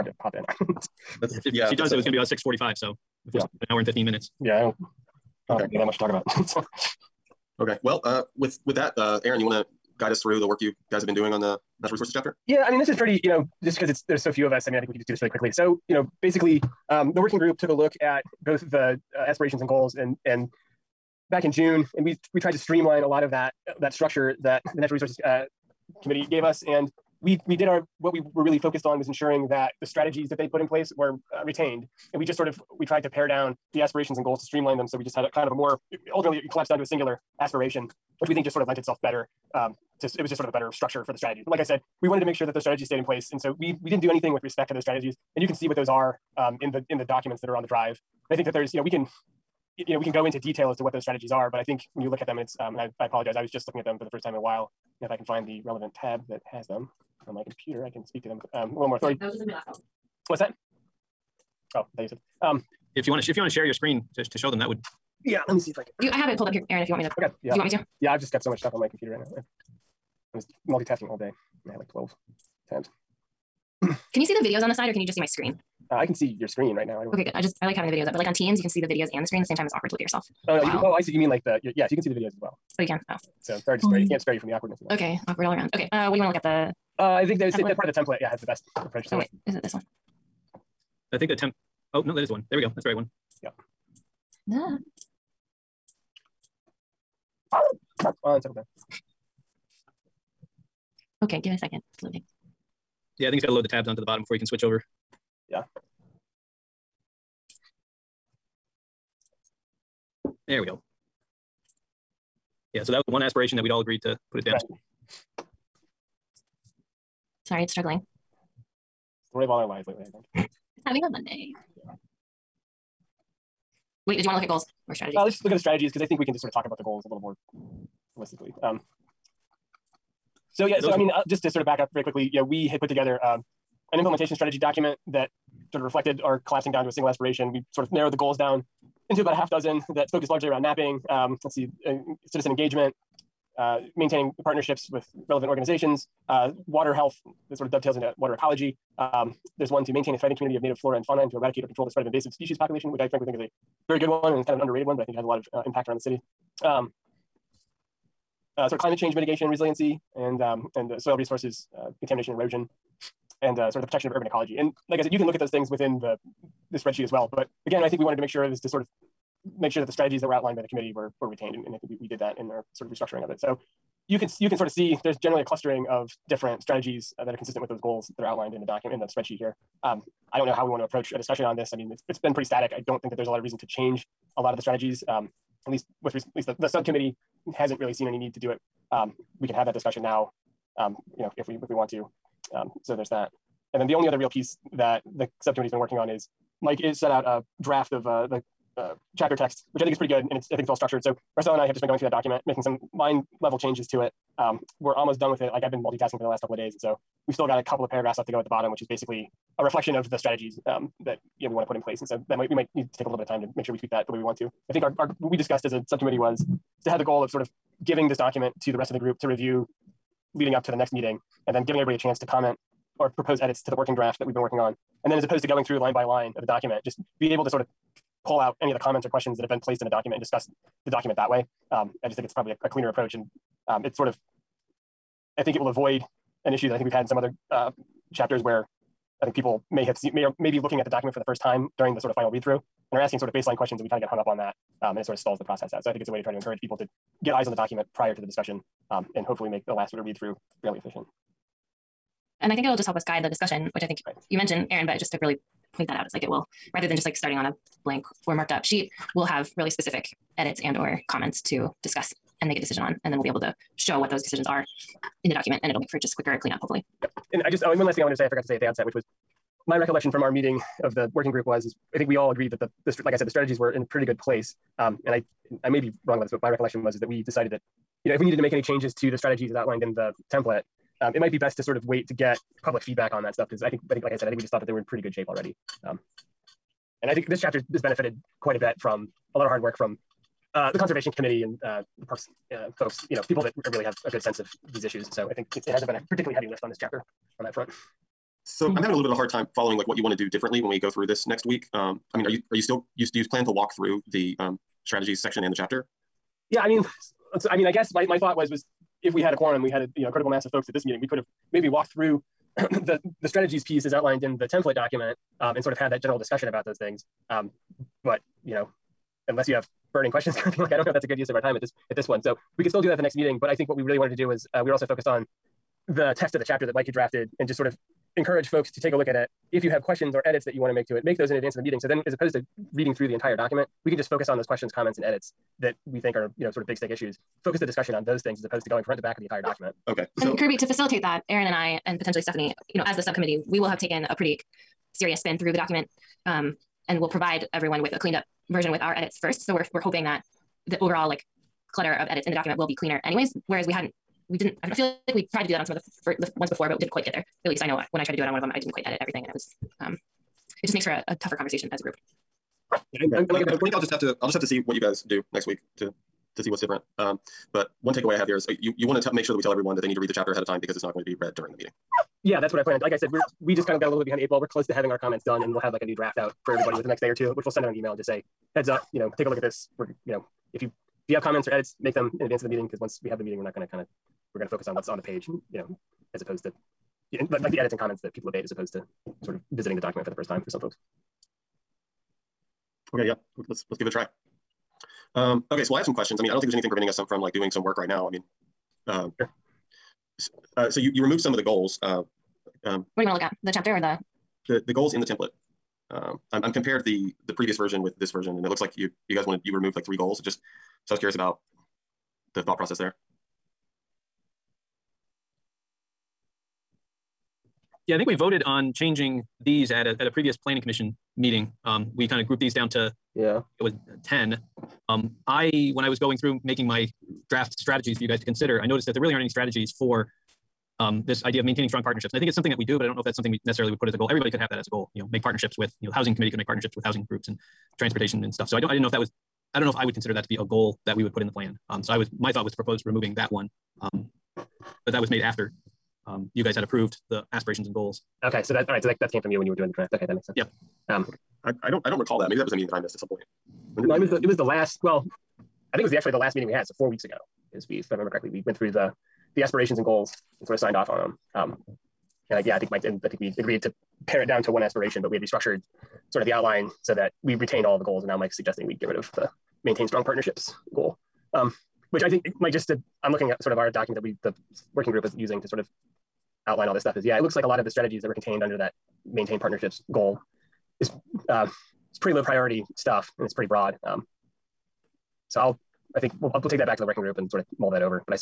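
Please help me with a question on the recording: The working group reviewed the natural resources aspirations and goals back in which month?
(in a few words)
June.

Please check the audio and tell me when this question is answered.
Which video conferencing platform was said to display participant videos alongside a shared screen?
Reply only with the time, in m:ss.
1:18.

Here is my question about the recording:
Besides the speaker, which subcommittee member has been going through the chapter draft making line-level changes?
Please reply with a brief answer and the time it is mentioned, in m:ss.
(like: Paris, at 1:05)
Marcel, at 3:21.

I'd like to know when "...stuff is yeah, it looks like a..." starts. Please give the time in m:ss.
7:56.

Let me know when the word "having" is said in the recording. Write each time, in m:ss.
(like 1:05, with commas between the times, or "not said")
1:17, 2:00, 4:58, 6:14.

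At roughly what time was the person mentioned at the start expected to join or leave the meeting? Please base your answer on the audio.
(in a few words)
645.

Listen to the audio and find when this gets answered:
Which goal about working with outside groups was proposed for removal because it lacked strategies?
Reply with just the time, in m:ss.
7:11.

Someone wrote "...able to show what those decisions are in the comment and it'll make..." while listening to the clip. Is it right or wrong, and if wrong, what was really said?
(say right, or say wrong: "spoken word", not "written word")
wrong: "document", not "comment".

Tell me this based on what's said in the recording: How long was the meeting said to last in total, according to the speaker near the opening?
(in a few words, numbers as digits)
an hour and 15 minutes.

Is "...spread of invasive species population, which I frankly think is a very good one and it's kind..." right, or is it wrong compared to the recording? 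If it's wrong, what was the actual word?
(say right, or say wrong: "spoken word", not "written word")
right.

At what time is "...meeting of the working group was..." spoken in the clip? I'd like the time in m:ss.
4:30.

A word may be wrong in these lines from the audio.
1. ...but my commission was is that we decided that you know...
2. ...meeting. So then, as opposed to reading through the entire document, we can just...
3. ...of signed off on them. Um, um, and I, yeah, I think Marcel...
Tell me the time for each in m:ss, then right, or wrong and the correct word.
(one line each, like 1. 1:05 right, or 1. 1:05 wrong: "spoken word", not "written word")
1. 4:36 wrong: "recollection", not "commission"
2. 5:31 right
3. 7:40 wrong: "Mike", not "Marcel".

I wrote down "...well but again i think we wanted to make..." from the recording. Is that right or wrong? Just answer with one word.
right.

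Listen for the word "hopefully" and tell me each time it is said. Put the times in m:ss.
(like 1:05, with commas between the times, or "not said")
4:09, 4:26.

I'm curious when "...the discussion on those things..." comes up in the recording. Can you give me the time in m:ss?
5:37.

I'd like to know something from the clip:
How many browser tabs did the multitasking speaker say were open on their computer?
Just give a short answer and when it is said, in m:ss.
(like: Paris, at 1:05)
12, at 1:11.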